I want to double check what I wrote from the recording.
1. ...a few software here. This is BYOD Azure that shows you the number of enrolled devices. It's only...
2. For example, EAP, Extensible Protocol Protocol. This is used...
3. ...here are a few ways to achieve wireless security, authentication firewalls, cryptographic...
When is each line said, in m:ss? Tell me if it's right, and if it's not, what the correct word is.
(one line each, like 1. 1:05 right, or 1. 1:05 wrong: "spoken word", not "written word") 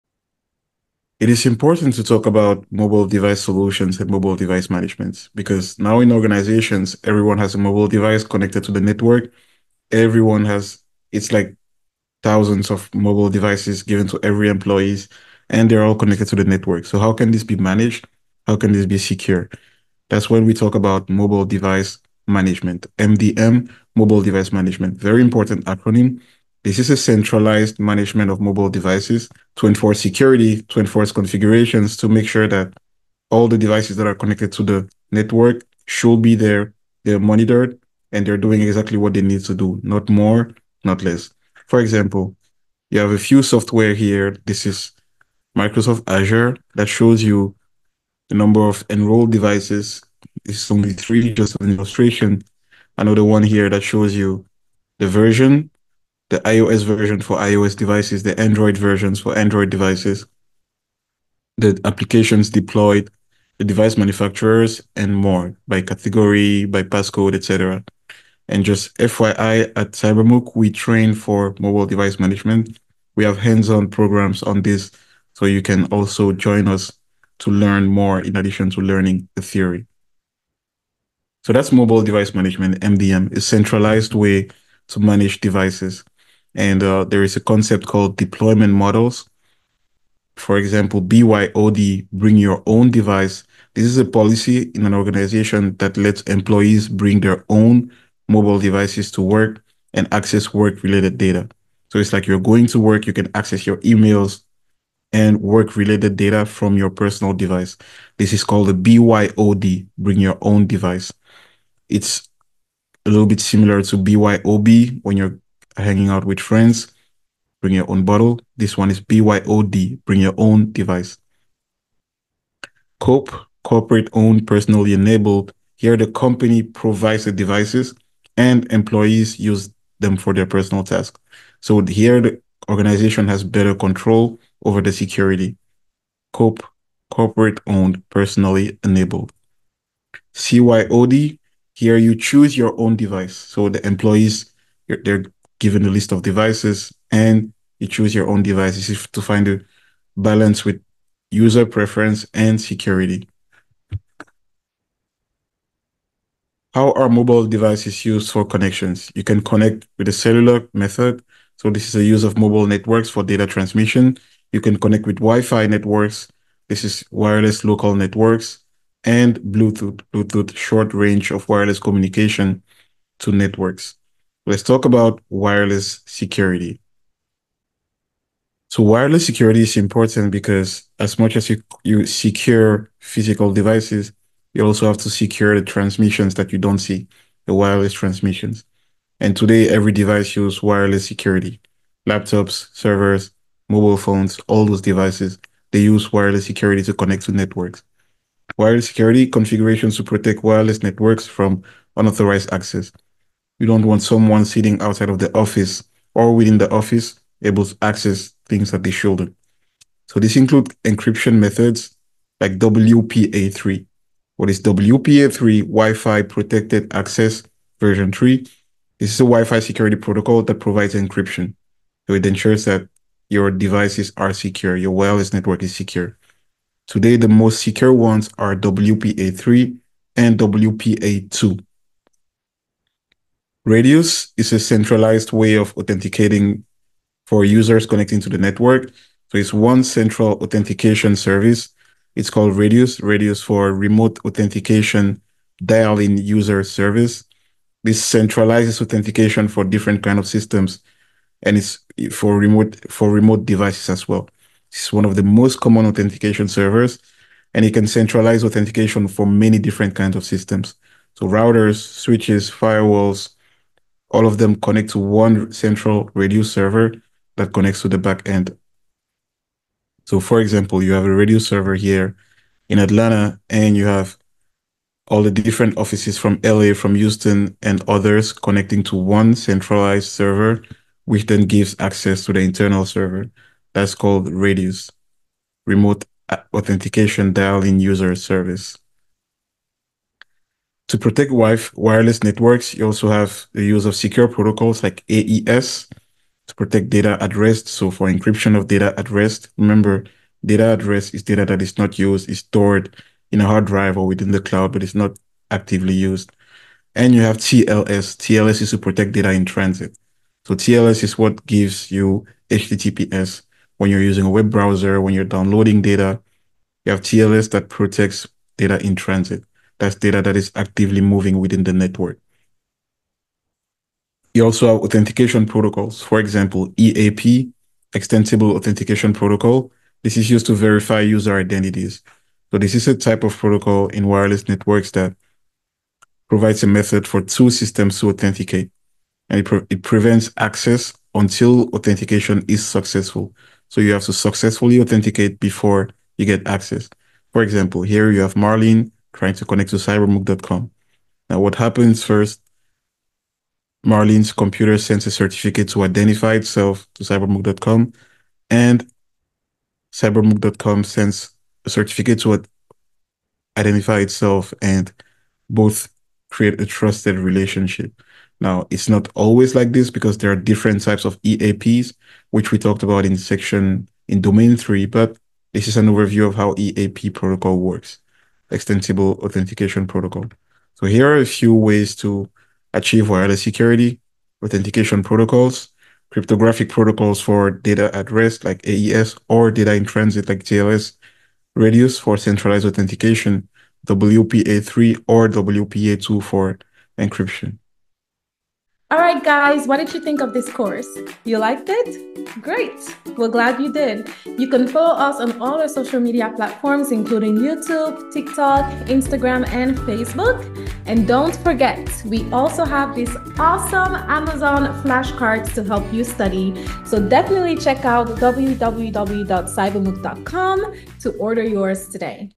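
1. 0:43 wrong: "Microsoft", not "BYOD"
2. 5:26 wrong: "Authentication", not "Protocol"
3. 6:20 wrong: "protocols", not "firewalls".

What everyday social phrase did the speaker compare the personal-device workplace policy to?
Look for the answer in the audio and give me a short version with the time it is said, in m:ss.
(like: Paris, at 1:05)
bring your own bottle, at 1:57.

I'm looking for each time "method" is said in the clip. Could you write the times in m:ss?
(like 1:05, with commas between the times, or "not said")
2:40, 3:31, 5:36.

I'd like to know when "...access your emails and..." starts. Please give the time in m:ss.
1:43.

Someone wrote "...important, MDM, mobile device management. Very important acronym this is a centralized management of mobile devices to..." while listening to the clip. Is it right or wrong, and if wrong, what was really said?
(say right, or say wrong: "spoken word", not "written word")
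wrong: "management", not "important".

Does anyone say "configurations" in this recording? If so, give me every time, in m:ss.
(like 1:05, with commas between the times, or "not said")
0:31, 3:19.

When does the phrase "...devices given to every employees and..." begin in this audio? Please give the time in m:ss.
0:13.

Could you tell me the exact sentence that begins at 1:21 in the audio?
So that's mobile device management, MDM, a centralized way to manage devices.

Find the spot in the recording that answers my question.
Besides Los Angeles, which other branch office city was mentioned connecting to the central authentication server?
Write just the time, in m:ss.
4:36.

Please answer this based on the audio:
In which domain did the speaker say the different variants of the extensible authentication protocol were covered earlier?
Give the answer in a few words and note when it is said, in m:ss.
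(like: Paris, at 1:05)
Domain 3, at 6:14.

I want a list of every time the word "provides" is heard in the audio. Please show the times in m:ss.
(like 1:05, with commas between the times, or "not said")
2:06, 3:40, 5:36.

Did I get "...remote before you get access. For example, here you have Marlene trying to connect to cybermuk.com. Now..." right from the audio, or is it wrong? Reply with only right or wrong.
wrong.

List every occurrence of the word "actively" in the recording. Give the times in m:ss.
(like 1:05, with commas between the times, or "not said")
5:05, 5:20.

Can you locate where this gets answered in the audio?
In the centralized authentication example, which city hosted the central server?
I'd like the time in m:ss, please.
4:32.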